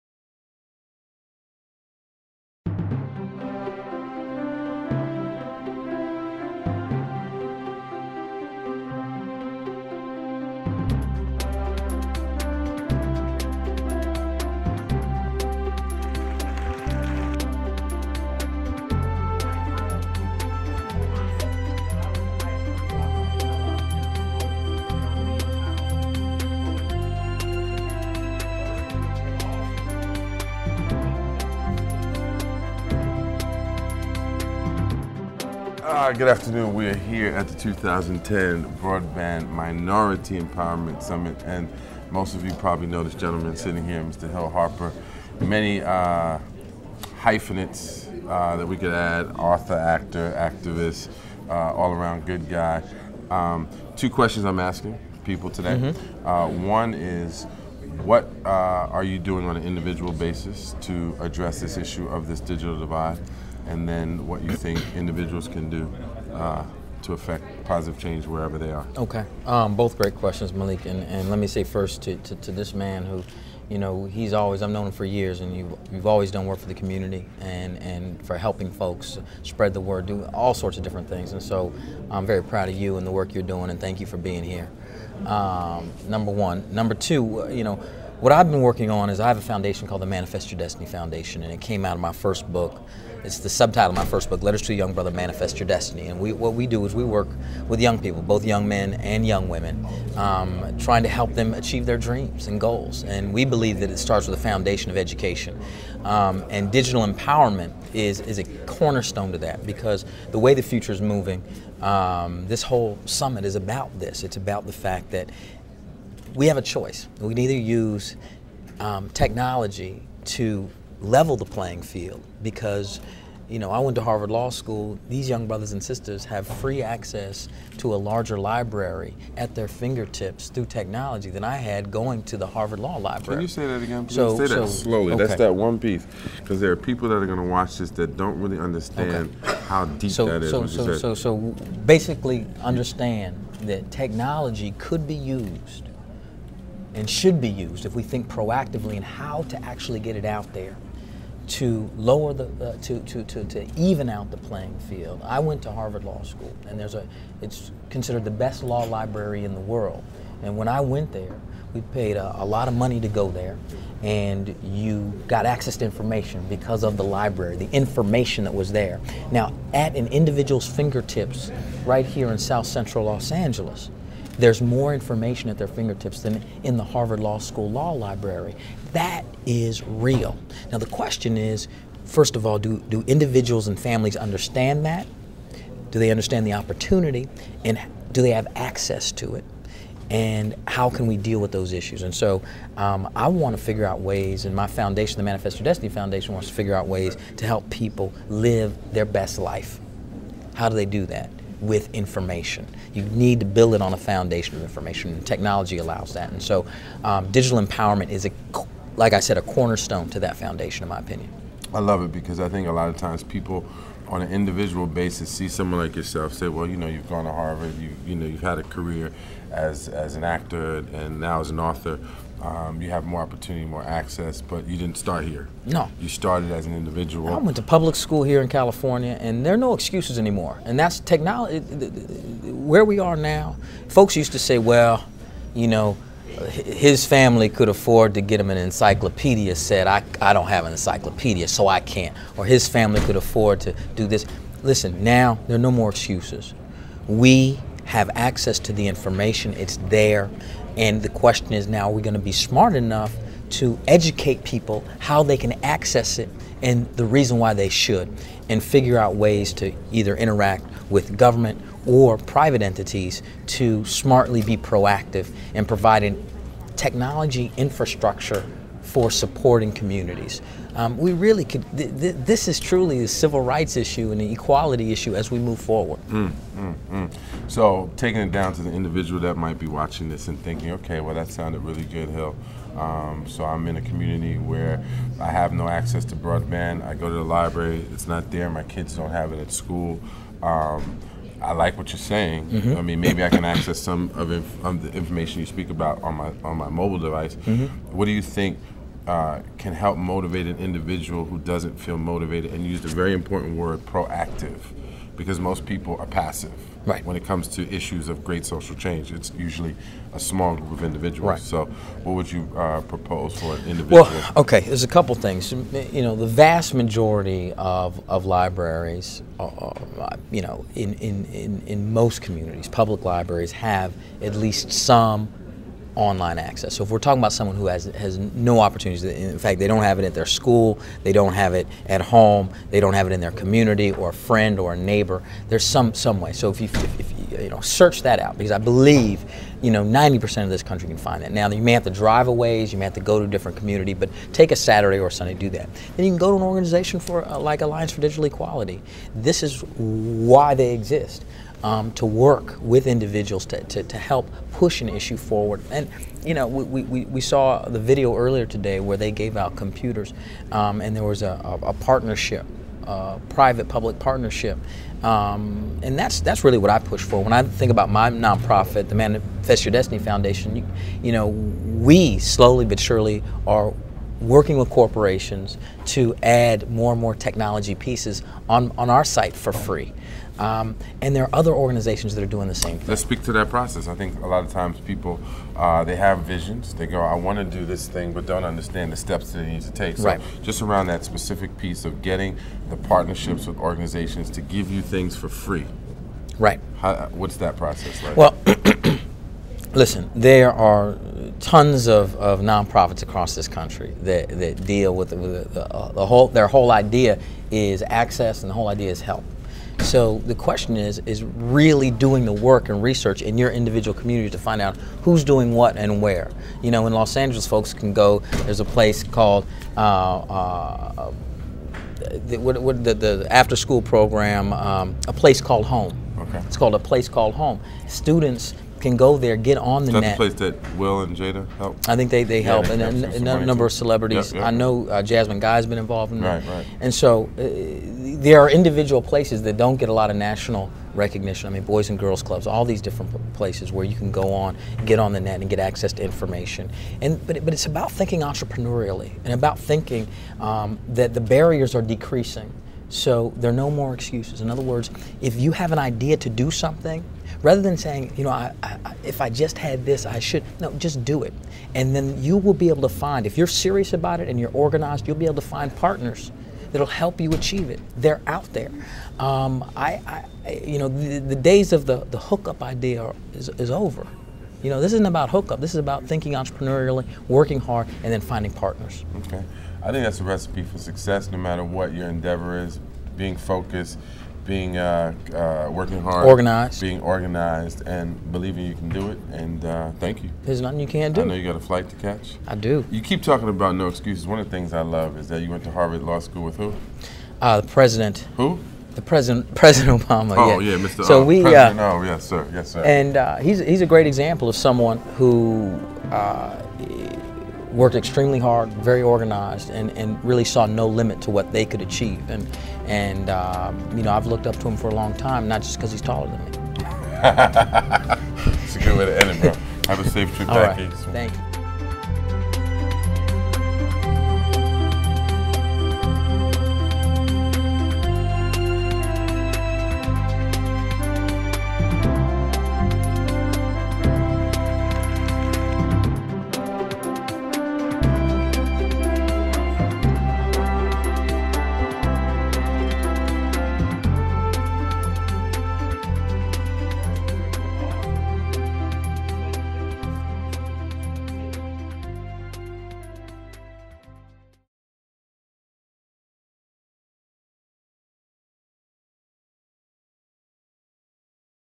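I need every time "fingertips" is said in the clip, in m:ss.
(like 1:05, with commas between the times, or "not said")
2:09, 2:50, 2:55.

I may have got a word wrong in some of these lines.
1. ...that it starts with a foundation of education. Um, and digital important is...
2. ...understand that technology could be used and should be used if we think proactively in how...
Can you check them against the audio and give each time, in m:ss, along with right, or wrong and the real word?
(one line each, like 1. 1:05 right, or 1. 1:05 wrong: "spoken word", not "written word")
1. 1:43 wrong: "empowerment", not "important"
2. 2:22 right.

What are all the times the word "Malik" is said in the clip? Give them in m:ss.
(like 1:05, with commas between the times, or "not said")
1:10.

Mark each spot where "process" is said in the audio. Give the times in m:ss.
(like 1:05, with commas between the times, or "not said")
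6:23, 6:37.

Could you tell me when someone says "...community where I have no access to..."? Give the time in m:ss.
4:43.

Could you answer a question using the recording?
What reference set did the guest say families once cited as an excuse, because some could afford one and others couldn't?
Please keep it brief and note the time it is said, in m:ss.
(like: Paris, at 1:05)
encyclopedia set, at 3:58.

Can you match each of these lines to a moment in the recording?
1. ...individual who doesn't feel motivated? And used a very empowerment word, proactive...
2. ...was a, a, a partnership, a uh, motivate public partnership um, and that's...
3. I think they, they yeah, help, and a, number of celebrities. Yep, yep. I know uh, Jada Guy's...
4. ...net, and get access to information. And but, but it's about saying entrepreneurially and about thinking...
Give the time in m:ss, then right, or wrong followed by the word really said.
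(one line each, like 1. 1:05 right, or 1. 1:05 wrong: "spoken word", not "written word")
1. 5:00 wrong: "important", not "empowerment"
2. 6:01 wrong: "private", not "motivate"
3. 7:11 wrong: "Jasmine", not "Jada"
4. 7:25 wrong: "thinking", not "saying".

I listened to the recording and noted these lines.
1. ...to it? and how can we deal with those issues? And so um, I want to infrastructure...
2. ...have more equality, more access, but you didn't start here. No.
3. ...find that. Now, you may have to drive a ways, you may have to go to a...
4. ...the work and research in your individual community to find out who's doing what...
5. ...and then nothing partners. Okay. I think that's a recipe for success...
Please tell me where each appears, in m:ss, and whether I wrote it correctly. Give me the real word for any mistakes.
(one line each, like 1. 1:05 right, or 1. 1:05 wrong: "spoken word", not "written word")
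1. 3:09 wrong: "figure", not "infrastructure"
2. 3:42 wrong: "opportunity", not "equality"
3. 5:40 right
4. 6:52 right
5. 7:58 wrong: "finding", not "nothing".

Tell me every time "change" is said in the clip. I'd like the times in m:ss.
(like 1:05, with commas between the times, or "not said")
1:07, 5:08.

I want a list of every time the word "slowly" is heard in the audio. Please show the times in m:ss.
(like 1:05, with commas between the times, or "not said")
2:14, 6:12.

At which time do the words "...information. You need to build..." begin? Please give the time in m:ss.
3:21.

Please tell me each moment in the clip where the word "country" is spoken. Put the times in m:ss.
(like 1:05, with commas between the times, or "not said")
5:40, 6:43.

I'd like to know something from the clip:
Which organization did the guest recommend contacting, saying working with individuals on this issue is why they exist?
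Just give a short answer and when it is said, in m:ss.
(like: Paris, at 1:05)
Alliance for Digital Equality, at 5:47.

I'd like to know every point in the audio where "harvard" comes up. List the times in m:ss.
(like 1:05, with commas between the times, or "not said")
2:04, 2:12, 2:35, 2:56, 3:37, 8:15.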